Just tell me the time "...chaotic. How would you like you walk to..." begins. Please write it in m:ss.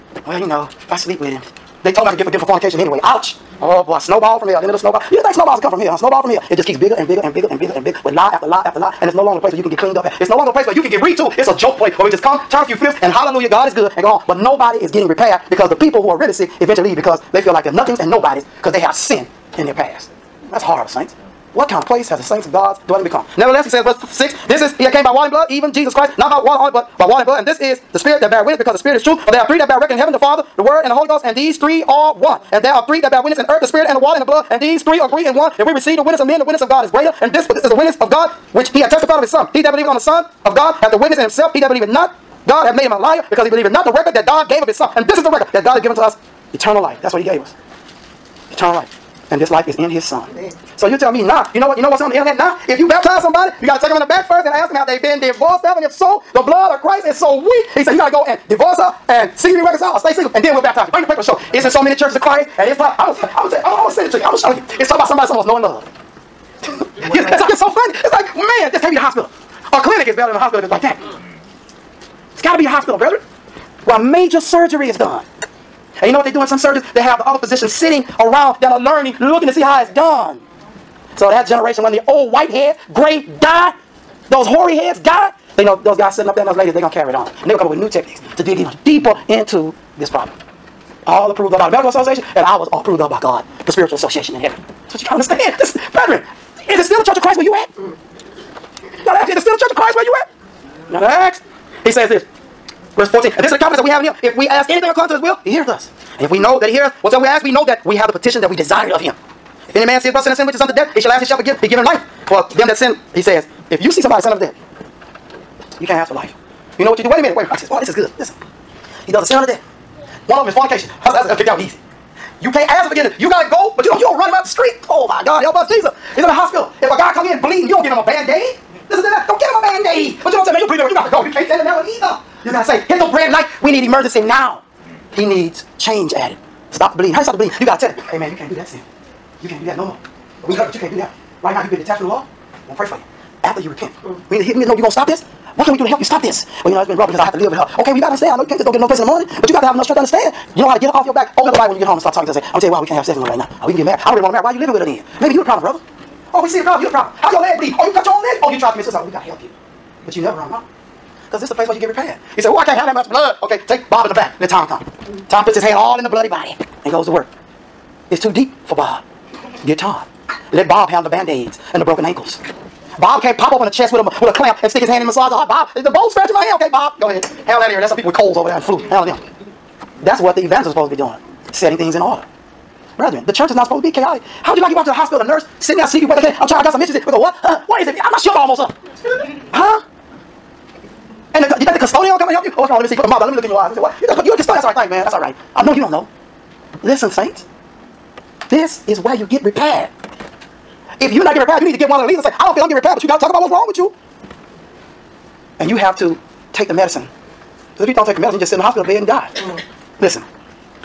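3:03.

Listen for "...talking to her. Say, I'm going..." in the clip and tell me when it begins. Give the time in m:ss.
2:32.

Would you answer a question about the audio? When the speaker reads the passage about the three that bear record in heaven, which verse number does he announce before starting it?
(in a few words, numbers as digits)
6.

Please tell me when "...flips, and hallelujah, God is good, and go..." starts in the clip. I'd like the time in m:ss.
0:12.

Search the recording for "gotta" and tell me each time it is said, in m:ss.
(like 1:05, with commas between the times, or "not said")
2:03, 2:12, 2:17.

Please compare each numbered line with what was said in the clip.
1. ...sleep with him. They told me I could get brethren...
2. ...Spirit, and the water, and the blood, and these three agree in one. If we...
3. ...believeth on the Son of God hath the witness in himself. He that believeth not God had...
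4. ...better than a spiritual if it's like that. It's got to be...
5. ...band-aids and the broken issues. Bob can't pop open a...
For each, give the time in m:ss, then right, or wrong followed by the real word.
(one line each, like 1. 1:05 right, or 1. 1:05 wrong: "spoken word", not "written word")
1. 0:00 wrong: "forgiven", not "brethren"
2. 0:33 right
3. 0:39 right
4. 1:10 wrong: "hospital", not "spiritual"
5. 2:51 wrong: "ankles", not "issues".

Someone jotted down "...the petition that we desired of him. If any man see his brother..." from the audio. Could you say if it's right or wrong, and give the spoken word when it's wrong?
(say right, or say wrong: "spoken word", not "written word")
right.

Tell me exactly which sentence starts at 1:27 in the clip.
And they're going to come up with new techniques to dig even deeper into this problem.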